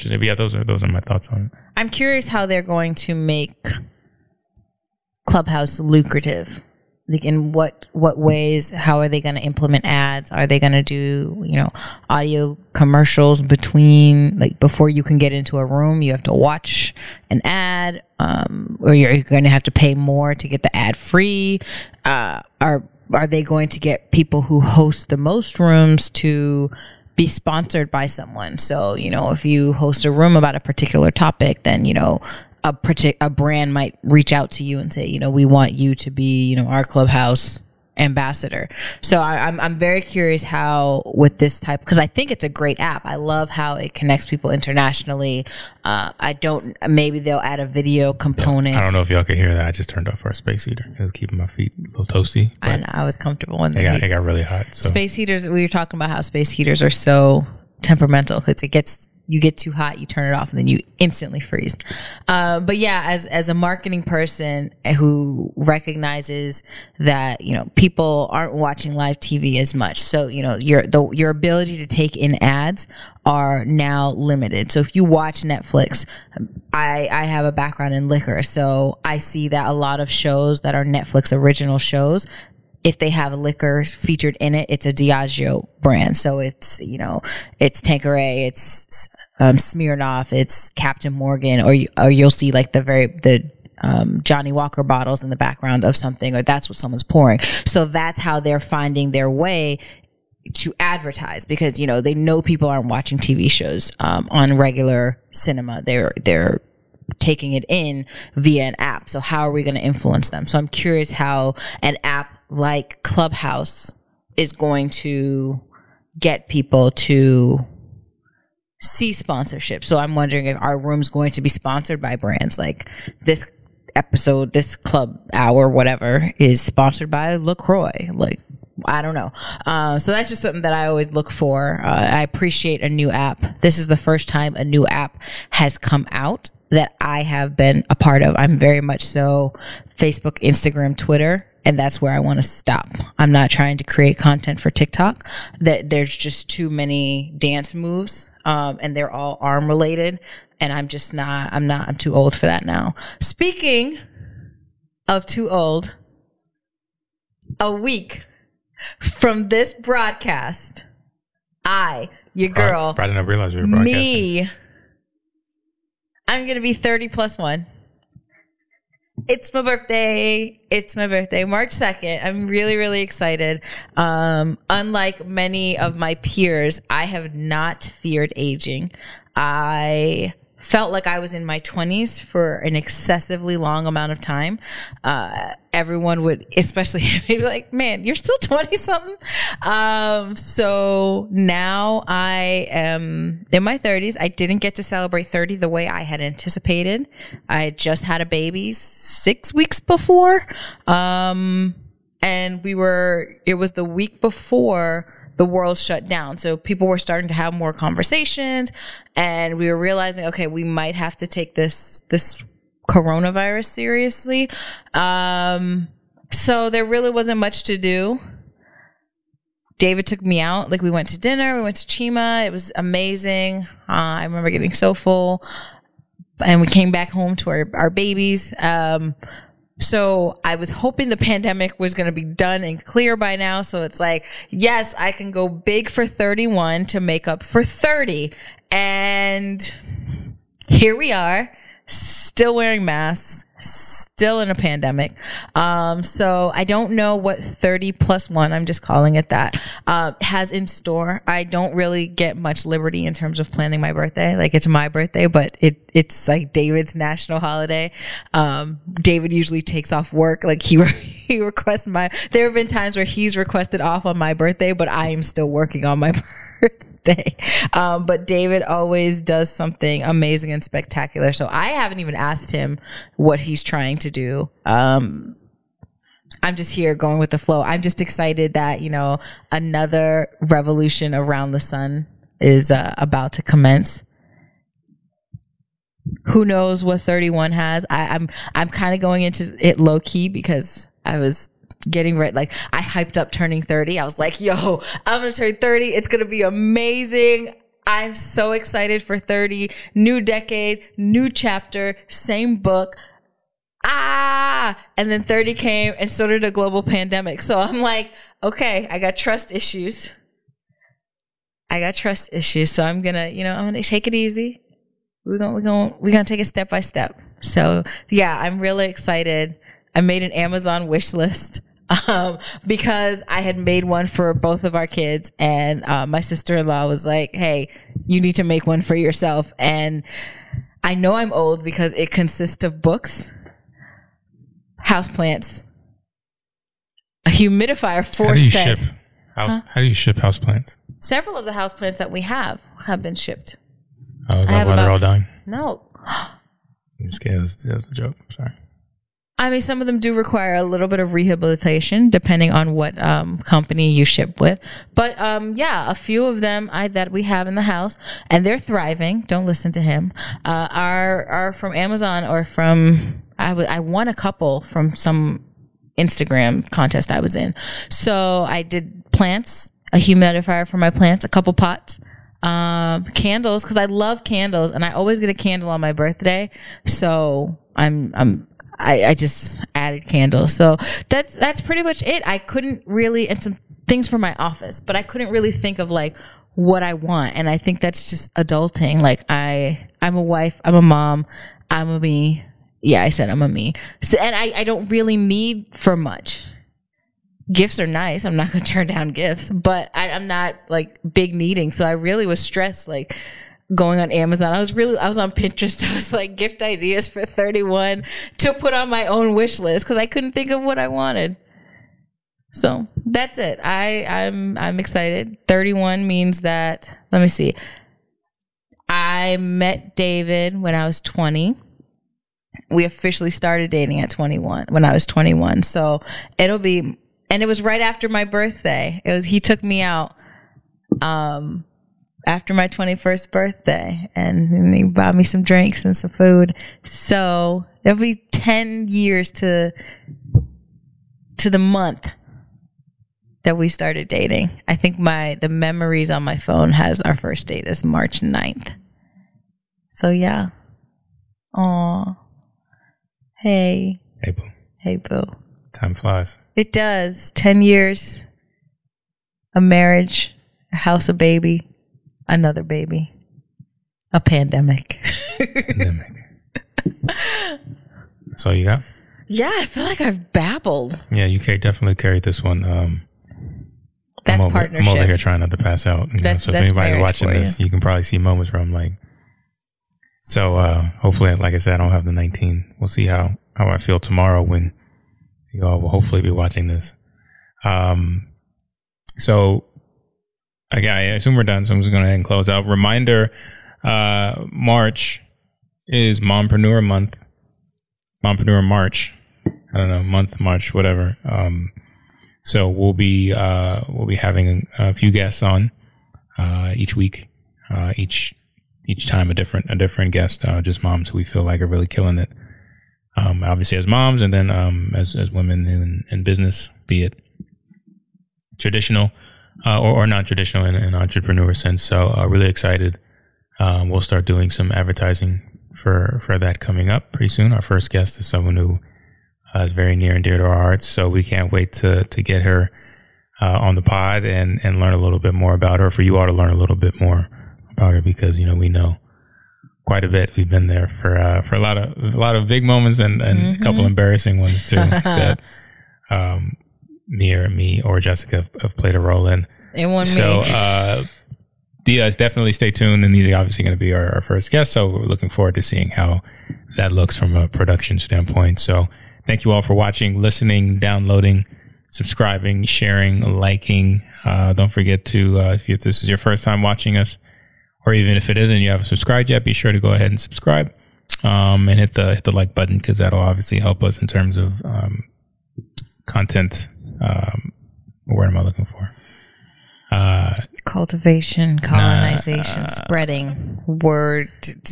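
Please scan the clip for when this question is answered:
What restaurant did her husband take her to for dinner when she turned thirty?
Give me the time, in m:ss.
3:41.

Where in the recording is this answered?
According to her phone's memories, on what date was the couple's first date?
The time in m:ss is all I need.
7:27.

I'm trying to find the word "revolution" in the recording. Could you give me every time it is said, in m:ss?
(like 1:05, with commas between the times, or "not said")
4:40.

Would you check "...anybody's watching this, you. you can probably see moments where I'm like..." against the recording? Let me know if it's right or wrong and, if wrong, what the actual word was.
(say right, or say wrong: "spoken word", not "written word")
right.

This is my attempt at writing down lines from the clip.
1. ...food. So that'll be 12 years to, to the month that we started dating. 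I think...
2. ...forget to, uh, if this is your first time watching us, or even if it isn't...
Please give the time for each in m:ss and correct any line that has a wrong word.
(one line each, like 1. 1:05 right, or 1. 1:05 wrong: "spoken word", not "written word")
1. 7:16 wrong: "10", not "12"
2. 9:24 right.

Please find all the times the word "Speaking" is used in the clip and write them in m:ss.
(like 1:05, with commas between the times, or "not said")
2:33.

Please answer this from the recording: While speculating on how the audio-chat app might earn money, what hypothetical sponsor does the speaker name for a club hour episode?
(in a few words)
LaCroix.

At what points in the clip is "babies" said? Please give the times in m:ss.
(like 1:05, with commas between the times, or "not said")
3:47.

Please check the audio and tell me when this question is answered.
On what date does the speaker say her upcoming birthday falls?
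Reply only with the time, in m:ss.
2:51.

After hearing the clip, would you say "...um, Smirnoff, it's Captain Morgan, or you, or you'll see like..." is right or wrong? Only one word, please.
right.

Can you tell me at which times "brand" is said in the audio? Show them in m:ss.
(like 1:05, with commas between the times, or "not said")
0:33, 1:25, 2:02.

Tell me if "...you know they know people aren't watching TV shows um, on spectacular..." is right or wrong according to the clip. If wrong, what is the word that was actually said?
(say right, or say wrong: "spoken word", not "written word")
wrong: "regular", not "spectacular".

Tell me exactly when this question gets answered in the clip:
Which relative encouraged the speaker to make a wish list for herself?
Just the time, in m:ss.
5:26.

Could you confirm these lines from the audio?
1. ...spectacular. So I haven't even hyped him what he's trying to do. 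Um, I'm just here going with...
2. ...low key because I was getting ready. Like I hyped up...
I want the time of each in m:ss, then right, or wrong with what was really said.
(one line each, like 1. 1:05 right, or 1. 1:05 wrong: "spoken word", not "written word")
1. 4:30 wrong: "asked", not "hyped"
2. 4:49 right.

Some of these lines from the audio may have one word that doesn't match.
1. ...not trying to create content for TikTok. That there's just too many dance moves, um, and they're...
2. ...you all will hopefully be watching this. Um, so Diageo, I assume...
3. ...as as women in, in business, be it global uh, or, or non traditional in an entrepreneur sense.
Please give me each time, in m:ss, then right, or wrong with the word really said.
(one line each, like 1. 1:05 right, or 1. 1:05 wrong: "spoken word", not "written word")
1. 2:23 right
2. 8:05 wrong: "Okay", not "Diageo"
3. 8:34 wrong: "traditional", not "global".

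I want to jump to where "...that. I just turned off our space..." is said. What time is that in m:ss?
0:49.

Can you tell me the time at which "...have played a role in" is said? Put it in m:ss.
9:08.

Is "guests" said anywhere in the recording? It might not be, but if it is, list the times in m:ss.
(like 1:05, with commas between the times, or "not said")
8:25, 8:30, 8:47, 9:14.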